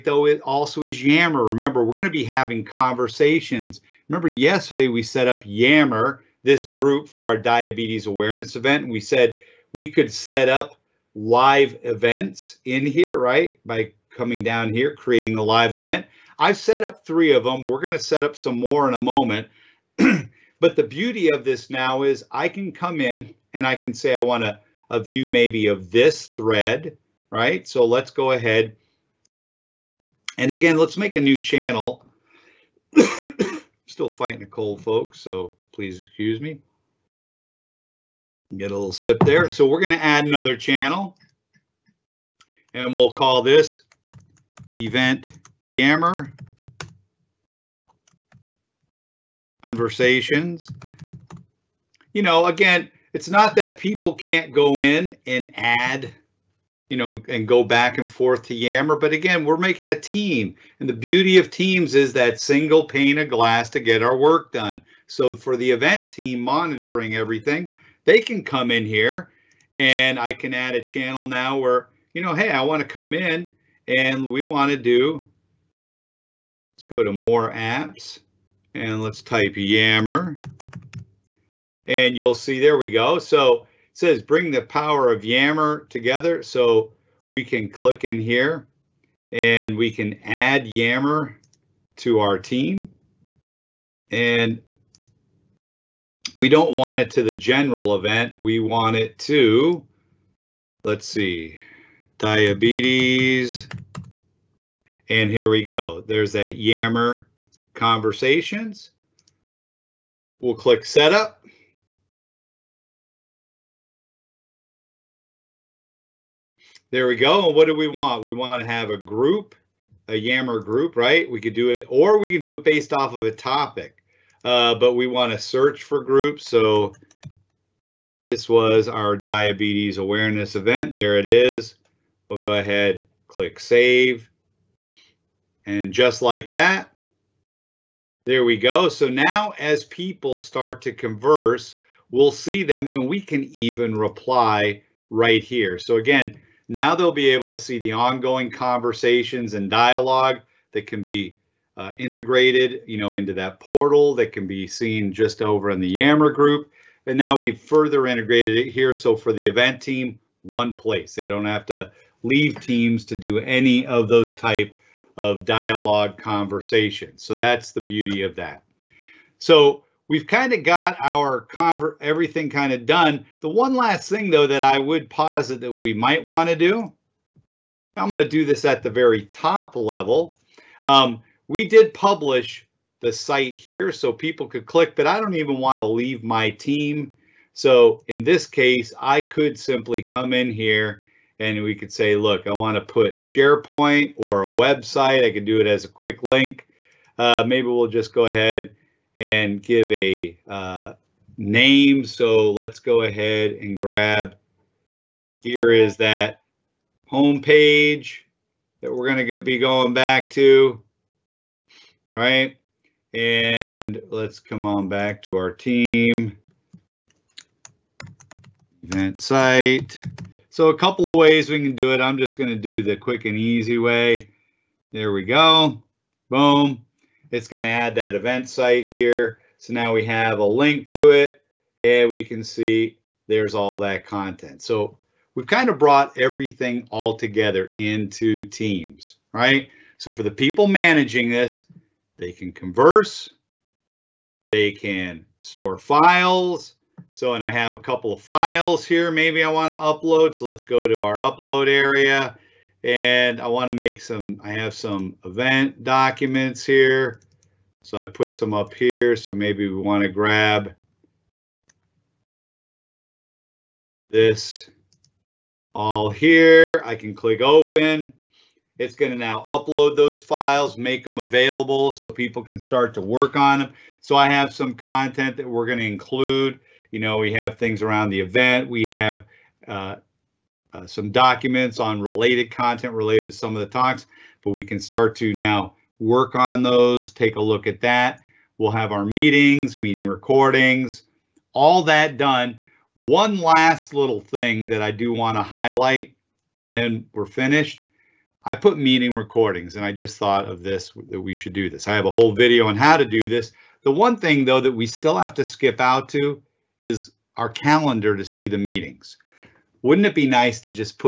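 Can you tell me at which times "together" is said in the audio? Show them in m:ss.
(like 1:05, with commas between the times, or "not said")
1:25, 3:57.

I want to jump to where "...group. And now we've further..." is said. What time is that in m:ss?
2:36.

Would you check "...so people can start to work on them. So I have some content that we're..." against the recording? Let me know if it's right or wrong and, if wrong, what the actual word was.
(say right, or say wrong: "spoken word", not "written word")
right.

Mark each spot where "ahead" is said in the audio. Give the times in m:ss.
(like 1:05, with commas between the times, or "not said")
0:28, 2:12, 3:18, 3:23.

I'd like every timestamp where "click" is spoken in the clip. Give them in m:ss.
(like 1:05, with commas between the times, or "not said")
1:27, 1:50, 2:13, 3:04, 4:27.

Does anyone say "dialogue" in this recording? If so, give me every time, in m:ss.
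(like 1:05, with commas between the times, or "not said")
2:29, 2:45.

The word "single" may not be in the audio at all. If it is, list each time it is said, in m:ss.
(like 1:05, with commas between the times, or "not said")
1:02.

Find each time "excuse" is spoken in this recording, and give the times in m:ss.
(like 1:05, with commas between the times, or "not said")
0:35.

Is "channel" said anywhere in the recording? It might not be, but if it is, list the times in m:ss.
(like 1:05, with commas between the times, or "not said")
0:31, 0:40, 1:10.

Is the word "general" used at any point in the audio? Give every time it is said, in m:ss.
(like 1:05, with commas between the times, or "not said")
1:37.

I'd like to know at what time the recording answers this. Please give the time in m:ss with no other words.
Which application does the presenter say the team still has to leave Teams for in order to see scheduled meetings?
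5:07.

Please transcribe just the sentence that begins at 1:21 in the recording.
And you'll see, there we go.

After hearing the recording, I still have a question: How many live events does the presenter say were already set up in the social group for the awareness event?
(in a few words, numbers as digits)
3.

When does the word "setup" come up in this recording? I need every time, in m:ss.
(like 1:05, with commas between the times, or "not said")
1:50.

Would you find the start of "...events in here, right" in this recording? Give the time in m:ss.
0:11.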